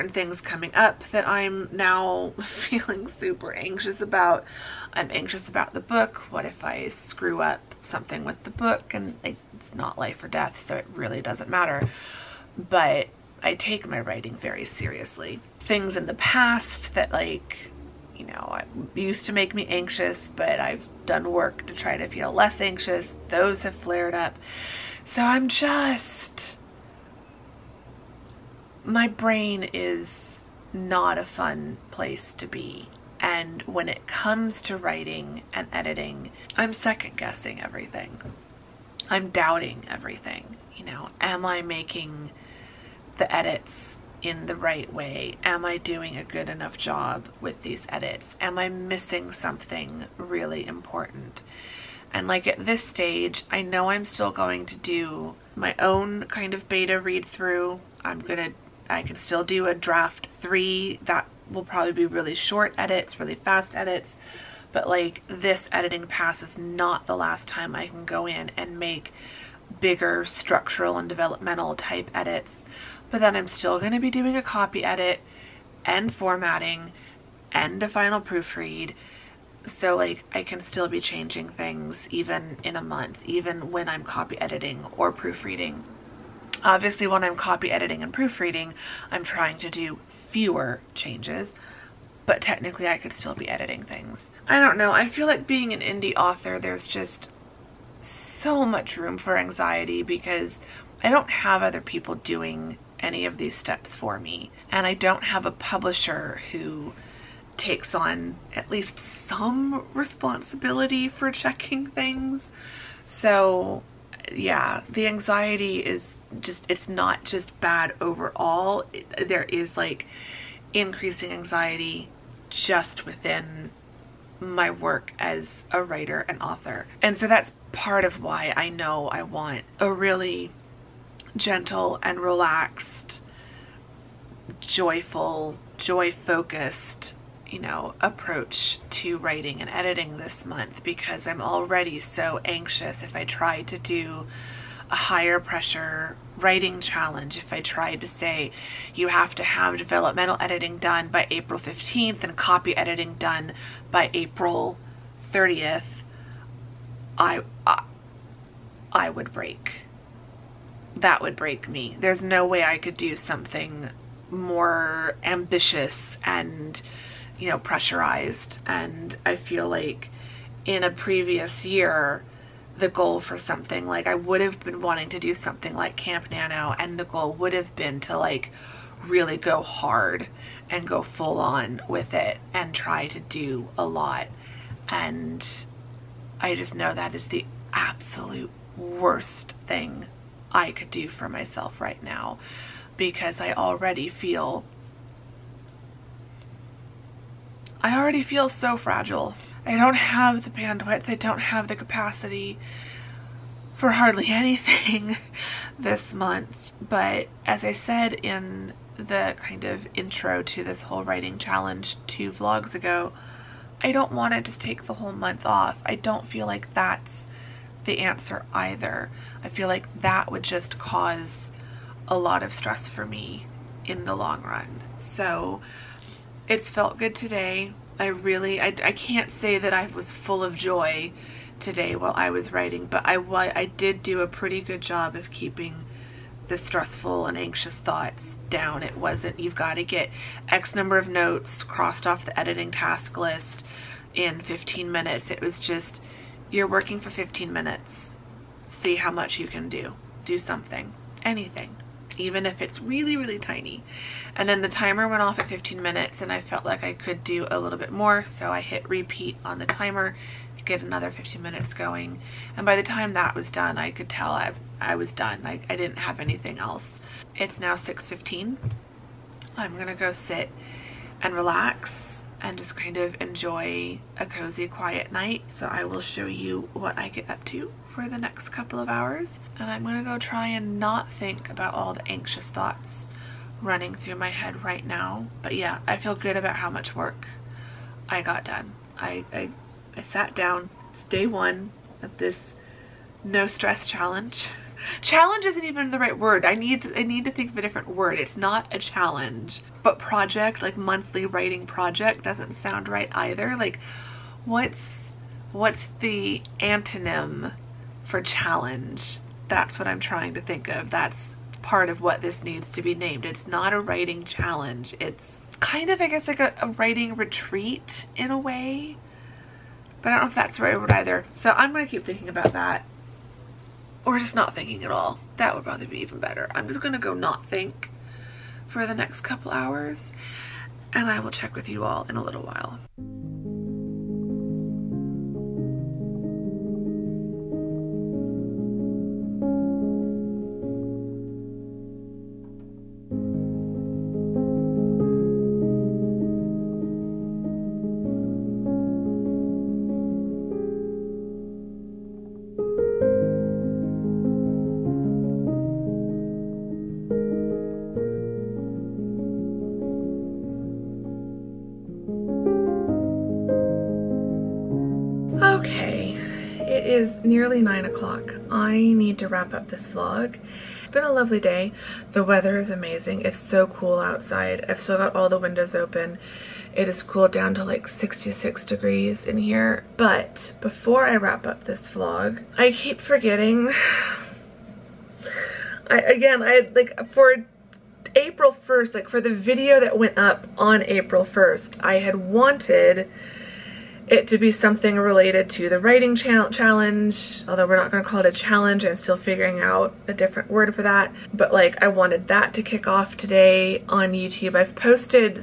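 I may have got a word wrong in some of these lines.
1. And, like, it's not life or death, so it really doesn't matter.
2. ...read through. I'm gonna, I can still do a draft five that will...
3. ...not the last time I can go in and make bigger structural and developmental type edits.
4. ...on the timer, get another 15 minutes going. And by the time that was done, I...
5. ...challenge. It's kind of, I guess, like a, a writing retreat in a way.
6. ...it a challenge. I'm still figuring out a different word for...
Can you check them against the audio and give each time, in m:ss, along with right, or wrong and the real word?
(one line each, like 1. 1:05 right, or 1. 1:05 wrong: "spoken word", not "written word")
1. 0:08 right
2. 0:56 wrong: "three", not "five"
3. 1:06 right
4. 4:19 right
5. 5:14 right
6. 6:38 right.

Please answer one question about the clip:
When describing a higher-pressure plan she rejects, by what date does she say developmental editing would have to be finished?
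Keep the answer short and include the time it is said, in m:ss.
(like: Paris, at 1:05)
April 15th, at 2:31.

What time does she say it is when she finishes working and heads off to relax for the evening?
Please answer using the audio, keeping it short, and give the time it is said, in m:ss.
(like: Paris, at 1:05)
6.15, at 4:27.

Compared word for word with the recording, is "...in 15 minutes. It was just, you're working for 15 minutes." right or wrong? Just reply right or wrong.
right.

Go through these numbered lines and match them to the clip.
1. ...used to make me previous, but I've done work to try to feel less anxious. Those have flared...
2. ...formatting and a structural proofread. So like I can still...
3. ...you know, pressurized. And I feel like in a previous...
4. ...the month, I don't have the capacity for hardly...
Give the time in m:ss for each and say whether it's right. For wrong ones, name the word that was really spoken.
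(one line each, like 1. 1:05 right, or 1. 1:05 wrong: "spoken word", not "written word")
1. 0:18 wrong: "anxious", not "previous"
2. 1:16 wrong: "final", not "structural"
3. 2:47 right
4. 3:20 wrong: "bandwidth", not "month".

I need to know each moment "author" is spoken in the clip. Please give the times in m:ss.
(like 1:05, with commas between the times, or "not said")
1:36, 2:06.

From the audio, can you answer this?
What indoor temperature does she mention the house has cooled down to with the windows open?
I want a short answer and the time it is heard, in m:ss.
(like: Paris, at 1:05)
66 degrees, at 6:17.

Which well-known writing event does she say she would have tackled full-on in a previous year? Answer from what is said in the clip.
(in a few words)
Camp Nano.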